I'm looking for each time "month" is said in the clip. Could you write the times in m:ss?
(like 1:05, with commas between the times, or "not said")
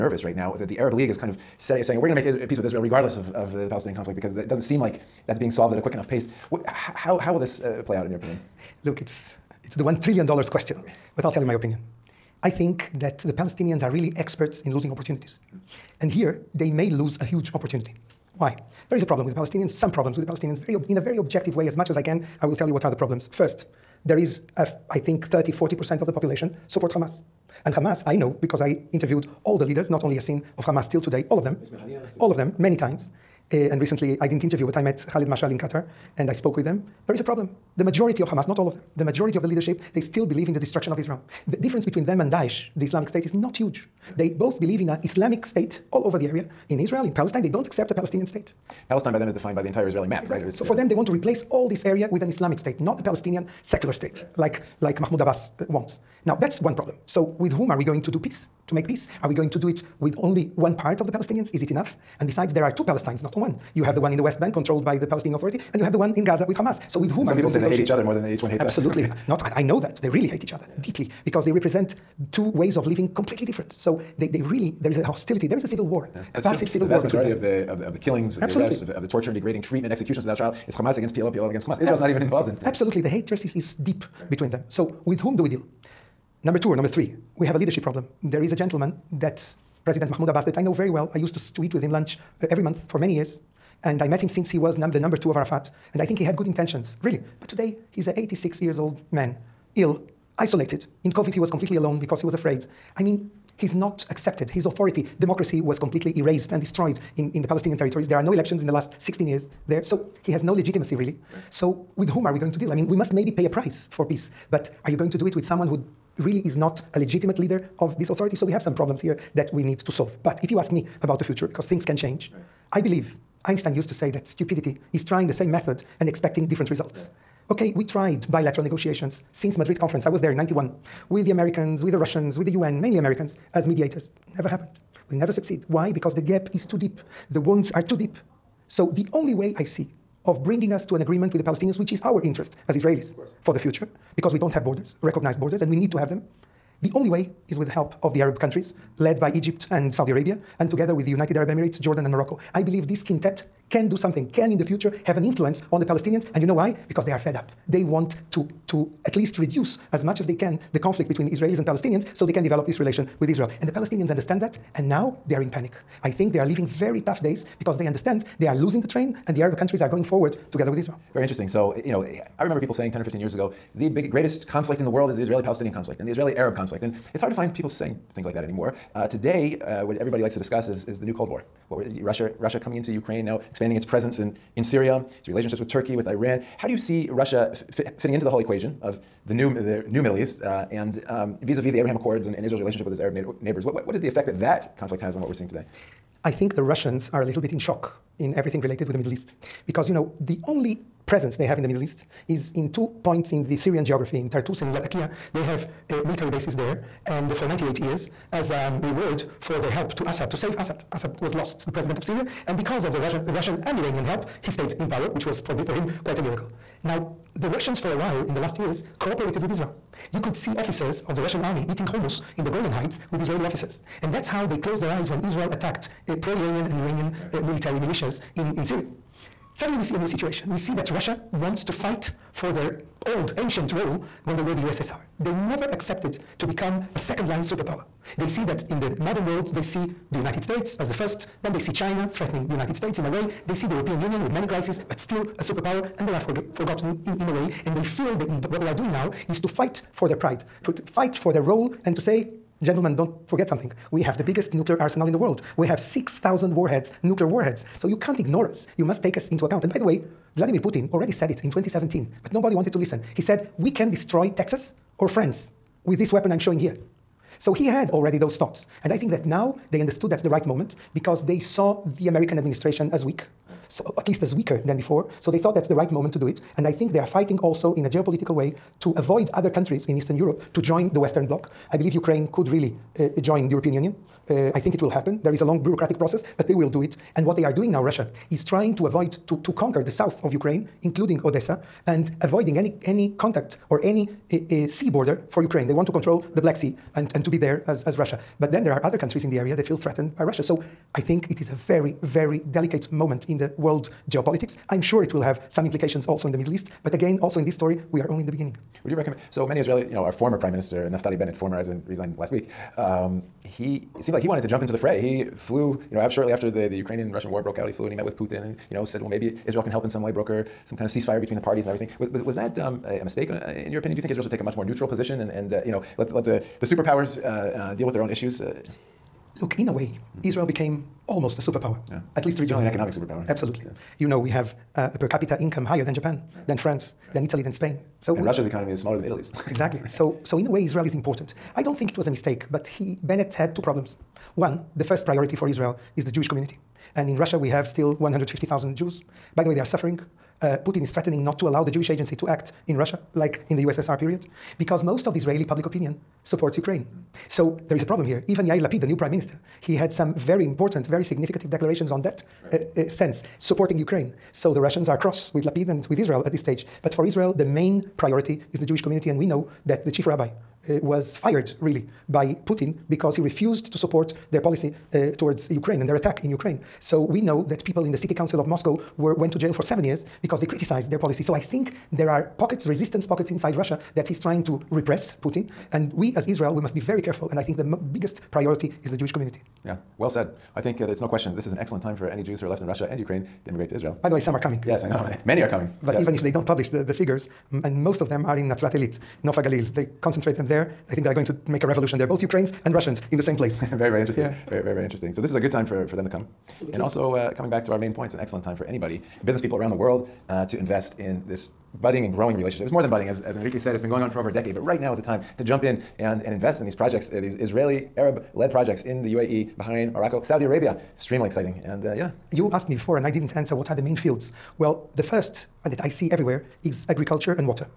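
1:32.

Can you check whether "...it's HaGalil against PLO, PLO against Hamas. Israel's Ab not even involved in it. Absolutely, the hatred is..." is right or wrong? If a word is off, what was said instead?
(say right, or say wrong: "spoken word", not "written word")
wrong: "Hamas", not "HaGalil".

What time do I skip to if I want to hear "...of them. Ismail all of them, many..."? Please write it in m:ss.
0:31.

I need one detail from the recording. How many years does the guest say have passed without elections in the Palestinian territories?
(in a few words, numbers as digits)
16.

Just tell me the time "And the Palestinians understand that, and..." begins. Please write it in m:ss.
2:43.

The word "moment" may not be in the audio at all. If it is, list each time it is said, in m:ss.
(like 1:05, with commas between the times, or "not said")
4:30, 4:35, 5:02.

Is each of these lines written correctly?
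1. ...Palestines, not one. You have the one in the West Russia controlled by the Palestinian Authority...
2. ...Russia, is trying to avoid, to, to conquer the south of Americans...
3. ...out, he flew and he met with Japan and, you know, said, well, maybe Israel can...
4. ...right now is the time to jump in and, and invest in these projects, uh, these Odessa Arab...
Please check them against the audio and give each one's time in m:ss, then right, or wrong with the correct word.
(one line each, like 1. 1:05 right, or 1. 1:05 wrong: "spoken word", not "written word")
1. 1:02 wrong: "Bank", not "Russia"
2. 4:47 wrong: "Ukraine", not "Americans"
3. 5:17 wrong: "Putin", not "Japan"
4. 6:54 wrong: "Israeli", not "Odessa".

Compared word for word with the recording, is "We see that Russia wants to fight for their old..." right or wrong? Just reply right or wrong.
right.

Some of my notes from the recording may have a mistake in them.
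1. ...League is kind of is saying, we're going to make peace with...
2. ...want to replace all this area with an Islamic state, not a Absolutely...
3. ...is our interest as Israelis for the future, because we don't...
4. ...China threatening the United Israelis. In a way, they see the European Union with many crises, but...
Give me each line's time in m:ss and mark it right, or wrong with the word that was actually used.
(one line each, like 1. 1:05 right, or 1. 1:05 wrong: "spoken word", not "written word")
1. 0:00 right
2. 0:50 wrong: "Palestinian", not "Absolutely"
3. 2:21 right
4. 4:01 wrong: "States", not "Israelis".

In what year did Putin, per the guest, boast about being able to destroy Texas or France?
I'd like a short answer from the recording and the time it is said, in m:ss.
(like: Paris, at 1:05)
2017, at 4:21.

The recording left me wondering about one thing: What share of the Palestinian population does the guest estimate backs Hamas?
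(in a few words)
30-40%.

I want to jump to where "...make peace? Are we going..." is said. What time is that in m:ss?
0:58.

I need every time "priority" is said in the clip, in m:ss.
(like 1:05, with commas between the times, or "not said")
5:45, 6:07, 6:28.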